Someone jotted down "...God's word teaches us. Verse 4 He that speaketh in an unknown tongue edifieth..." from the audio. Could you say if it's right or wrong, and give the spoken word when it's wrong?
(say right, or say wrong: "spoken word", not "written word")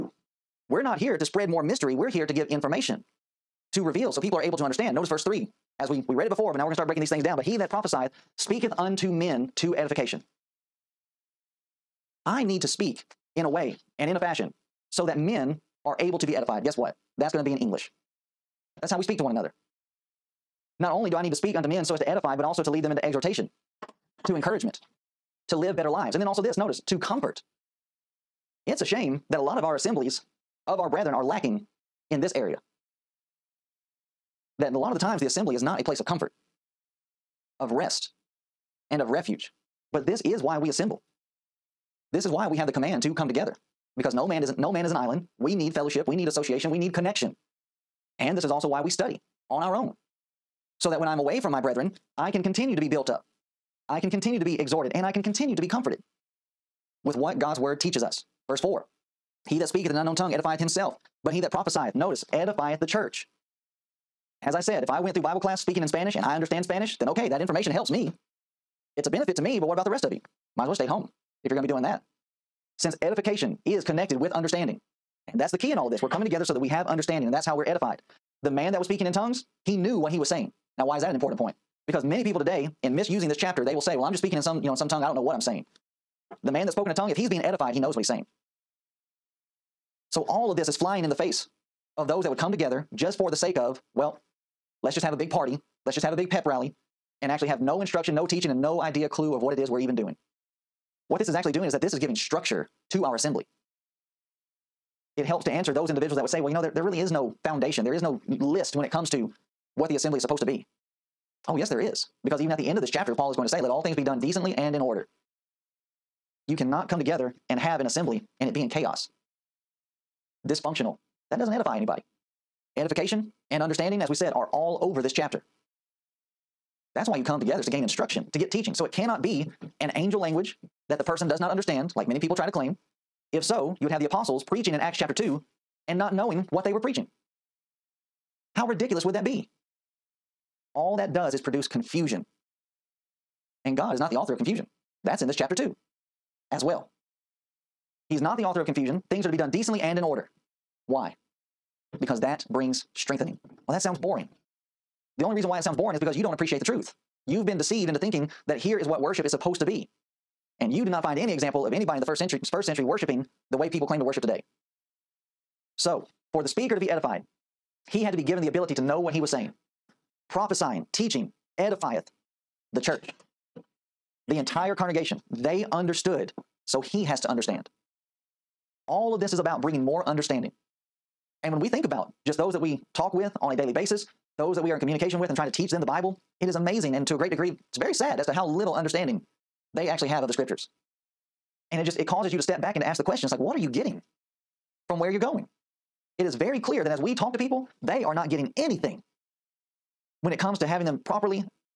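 right.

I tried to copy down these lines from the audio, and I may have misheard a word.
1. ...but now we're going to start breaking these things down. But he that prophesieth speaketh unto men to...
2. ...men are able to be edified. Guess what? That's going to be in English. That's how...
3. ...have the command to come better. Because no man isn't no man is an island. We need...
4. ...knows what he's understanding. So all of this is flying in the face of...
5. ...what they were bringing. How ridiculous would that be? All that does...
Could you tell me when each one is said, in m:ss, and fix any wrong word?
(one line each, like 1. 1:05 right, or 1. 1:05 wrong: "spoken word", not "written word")
1. 0:06 right
2. 0:15 right
3. 0:42 wrong: "together", not "better"
4. 1:27 wrong: "saying", not "understanding"
5. 2:16 wrong: "preaching", not "bringing".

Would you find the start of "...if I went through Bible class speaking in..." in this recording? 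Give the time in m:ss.
1:04.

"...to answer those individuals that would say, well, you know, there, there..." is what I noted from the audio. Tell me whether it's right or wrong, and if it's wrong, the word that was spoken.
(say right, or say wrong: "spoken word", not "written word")
right.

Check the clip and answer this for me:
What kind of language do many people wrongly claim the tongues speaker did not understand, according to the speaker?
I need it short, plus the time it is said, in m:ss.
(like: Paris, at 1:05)
Angel language, at 2:09.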